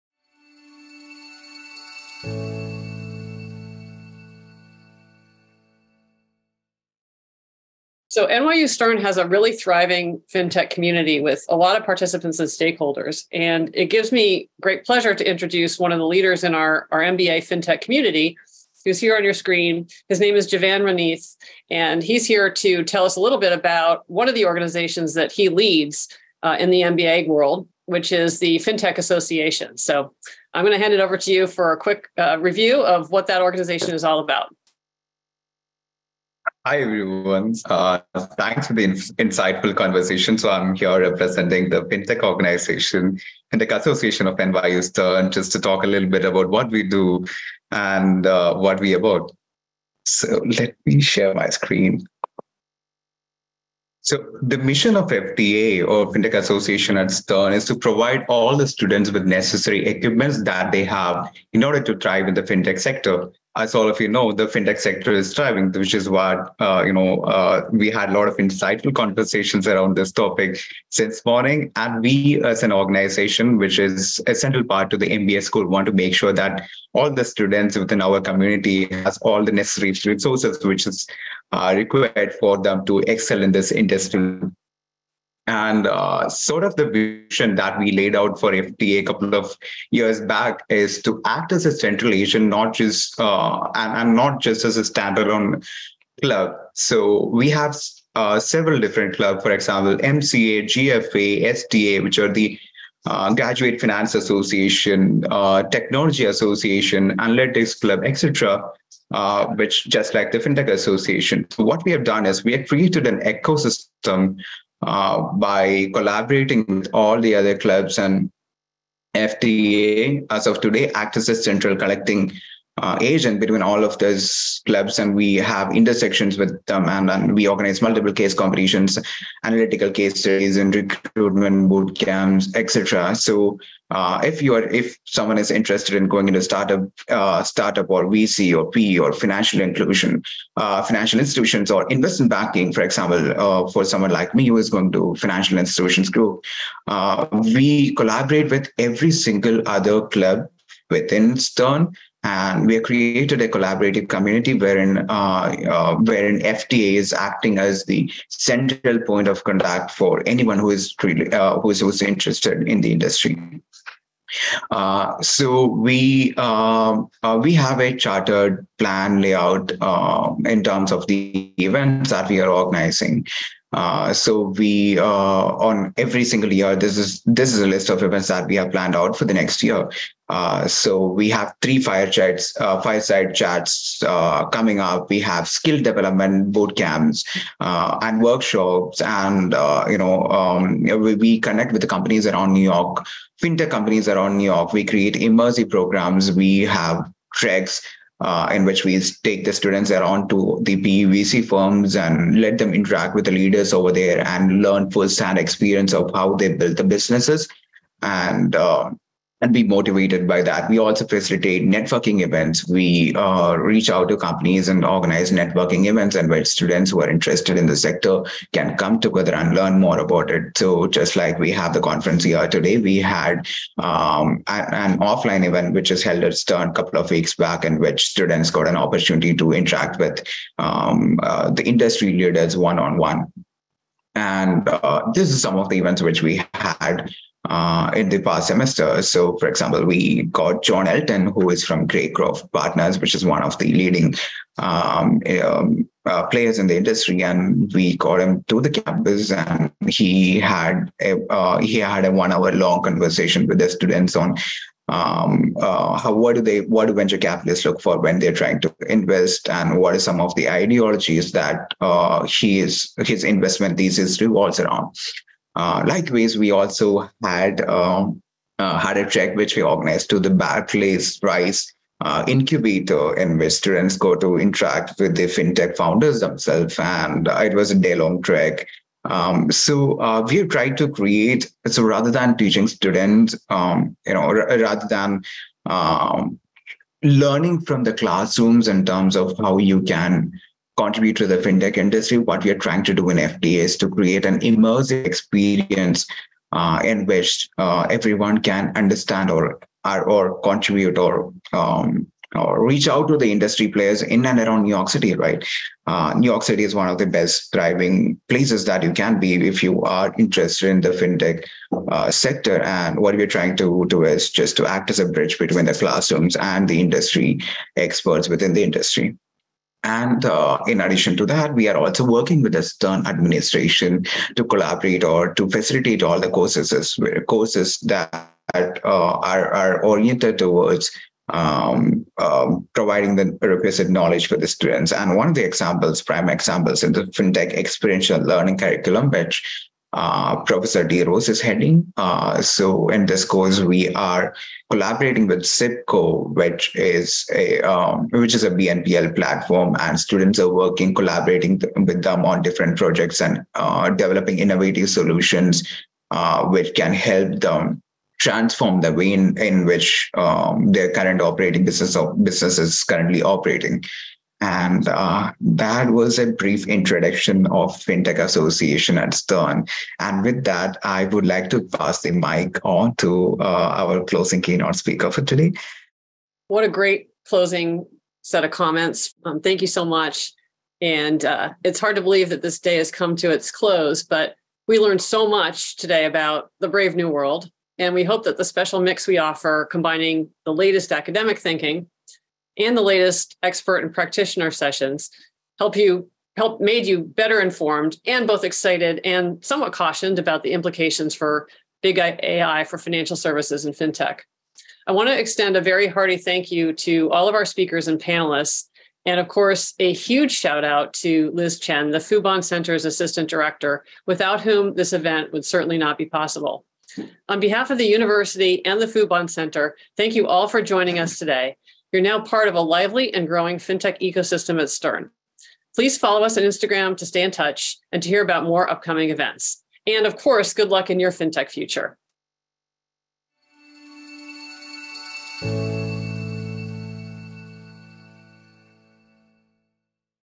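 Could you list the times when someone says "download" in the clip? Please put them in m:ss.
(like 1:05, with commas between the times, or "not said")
not said.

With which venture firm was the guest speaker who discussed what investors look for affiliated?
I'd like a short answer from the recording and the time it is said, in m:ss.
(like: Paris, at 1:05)
Greycroft Partners, at 4:01.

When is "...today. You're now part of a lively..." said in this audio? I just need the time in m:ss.
7:01.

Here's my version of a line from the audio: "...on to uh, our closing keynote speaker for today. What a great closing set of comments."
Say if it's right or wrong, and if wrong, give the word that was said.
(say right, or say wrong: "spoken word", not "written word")
right.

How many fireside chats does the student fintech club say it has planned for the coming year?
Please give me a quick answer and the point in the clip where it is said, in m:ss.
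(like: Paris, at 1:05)
3, at 3:01.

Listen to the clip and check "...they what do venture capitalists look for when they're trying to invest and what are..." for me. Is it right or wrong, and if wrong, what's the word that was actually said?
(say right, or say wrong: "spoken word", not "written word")
right.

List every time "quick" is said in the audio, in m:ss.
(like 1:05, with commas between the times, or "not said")
0:31.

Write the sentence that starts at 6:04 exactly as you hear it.
And uh, that was a brief introduction of FinTech Association at Stern.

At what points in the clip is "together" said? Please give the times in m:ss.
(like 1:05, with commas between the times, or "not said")
3:38.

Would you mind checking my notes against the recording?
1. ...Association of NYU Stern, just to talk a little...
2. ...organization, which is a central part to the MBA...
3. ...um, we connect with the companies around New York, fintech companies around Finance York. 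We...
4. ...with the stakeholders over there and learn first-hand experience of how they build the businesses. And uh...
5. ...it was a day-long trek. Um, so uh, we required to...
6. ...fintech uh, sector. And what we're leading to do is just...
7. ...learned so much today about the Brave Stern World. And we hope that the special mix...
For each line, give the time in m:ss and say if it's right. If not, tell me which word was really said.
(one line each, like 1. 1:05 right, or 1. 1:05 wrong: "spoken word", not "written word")
1. 0:43 right
2. 1:12 right
3. 3:10 wrong: "New", not "Finance"
4. 3:23 wrong: "leaders", not "stakeholders"
5. 4:37 wrong: "tried", not "required"
6. 5:10 wrong: "trying", not "leading"
7. 6:24 wrong: "New", not "Stern".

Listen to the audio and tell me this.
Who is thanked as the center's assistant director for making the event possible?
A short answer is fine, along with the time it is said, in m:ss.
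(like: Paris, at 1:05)
Liz Chen, at 6:51.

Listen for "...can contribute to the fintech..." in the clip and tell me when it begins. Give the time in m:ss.
4:49.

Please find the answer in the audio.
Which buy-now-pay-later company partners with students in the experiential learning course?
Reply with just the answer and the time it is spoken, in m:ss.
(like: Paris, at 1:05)
Zip Co, at 5:45.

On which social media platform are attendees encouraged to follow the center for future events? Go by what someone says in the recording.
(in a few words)
Instagram.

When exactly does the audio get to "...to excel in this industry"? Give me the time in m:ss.
1:22.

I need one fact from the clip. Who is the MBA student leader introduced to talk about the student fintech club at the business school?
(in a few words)
Jeevan Renjith.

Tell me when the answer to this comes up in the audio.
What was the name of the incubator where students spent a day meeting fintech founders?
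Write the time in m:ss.
4:30.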